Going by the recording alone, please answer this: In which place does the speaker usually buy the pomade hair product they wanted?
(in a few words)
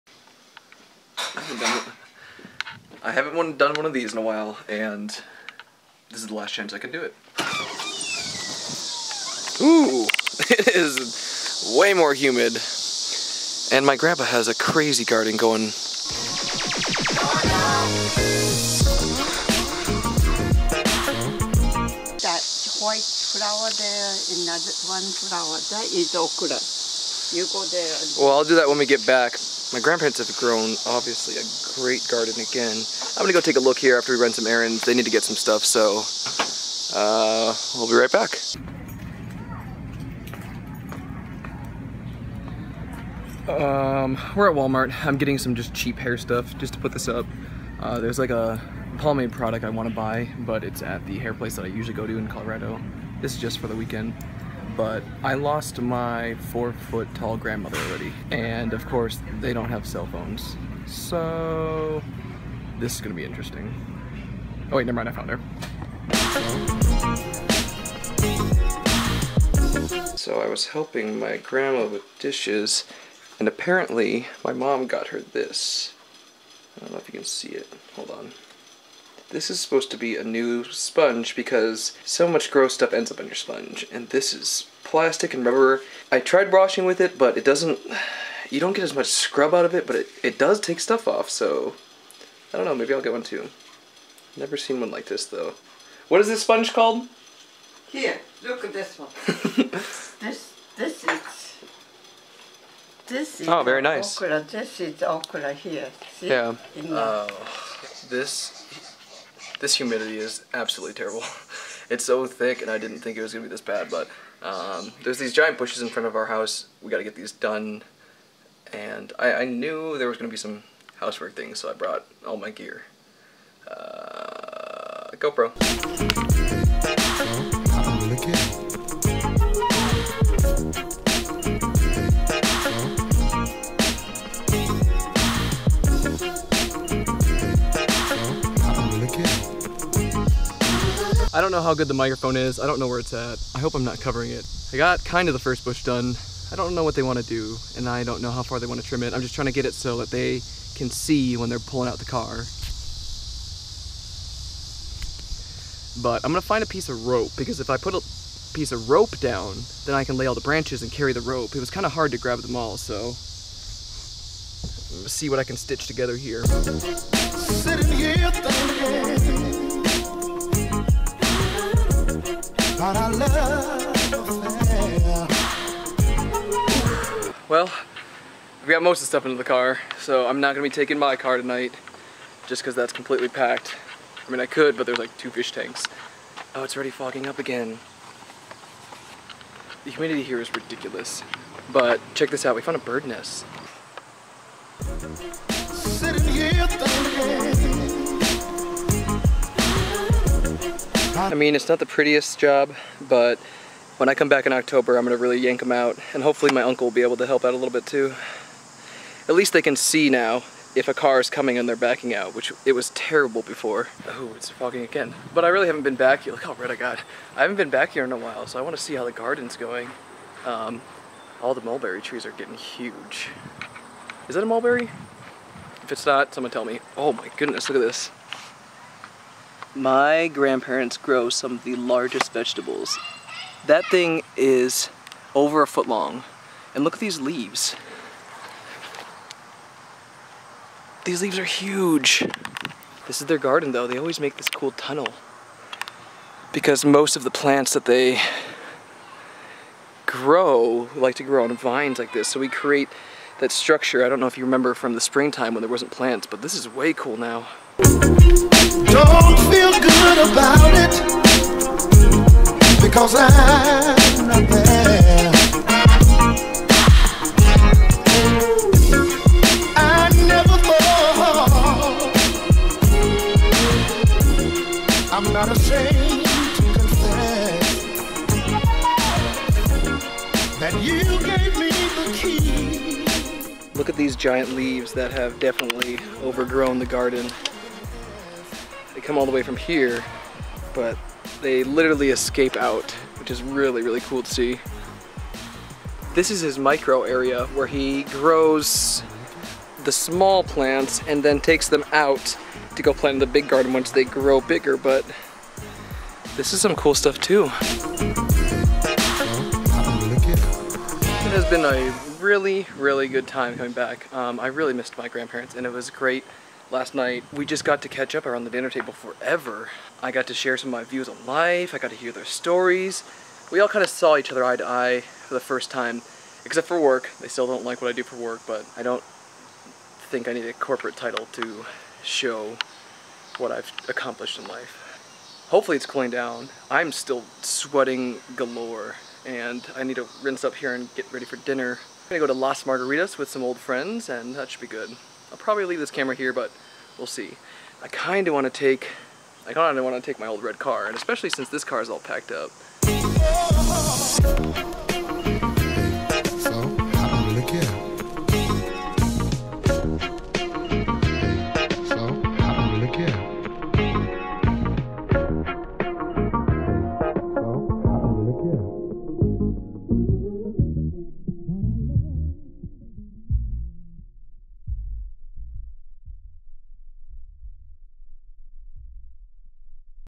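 Colorado.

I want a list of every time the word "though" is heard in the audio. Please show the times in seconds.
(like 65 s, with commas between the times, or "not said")
95 s, 243 s.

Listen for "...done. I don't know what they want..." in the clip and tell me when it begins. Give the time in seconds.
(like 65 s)
145 s.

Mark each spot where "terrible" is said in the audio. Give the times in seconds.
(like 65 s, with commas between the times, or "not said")
110 s, 212 s.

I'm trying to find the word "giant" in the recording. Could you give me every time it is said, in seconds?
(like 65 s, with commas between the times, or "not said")
115 s, 284 s.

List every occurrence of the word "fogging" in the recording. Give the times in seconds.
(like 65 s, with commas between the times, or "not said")
186 s, 214 s.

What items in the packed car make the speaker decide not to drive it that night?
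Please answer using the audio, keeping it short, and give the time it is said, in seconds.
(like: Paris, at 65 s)
2 fish tanks, at 185 s.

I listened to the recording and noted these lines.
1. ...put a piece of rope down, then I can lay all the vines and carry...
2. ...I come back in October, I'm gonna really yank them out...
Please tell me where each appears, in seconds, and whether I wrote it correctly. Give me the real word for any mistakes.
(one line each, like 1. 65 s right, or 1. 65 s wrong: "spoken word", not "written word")
1. 157 s wrong: "branches", not "vines"
2. 204 s right.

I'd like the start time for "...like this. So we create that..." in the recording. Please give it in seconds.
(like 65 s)
251 s.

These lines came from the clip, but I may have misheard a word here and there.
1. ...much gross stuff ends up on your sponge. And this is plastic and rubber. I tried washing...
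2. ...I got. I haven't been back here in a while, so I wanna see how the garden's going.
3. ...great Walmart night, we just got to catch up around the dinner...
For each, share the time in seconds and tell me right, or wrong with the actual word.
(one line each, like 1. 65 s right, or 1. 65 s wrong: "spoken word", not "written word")
1. 82 s right
2. 216 s right
3. 315 s wrong: "Last", not "Walmart".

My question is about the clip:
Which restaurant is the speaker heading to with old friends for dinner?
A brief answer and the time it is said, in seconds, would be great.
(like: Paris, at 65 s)
Las Margaritas, at 342 s.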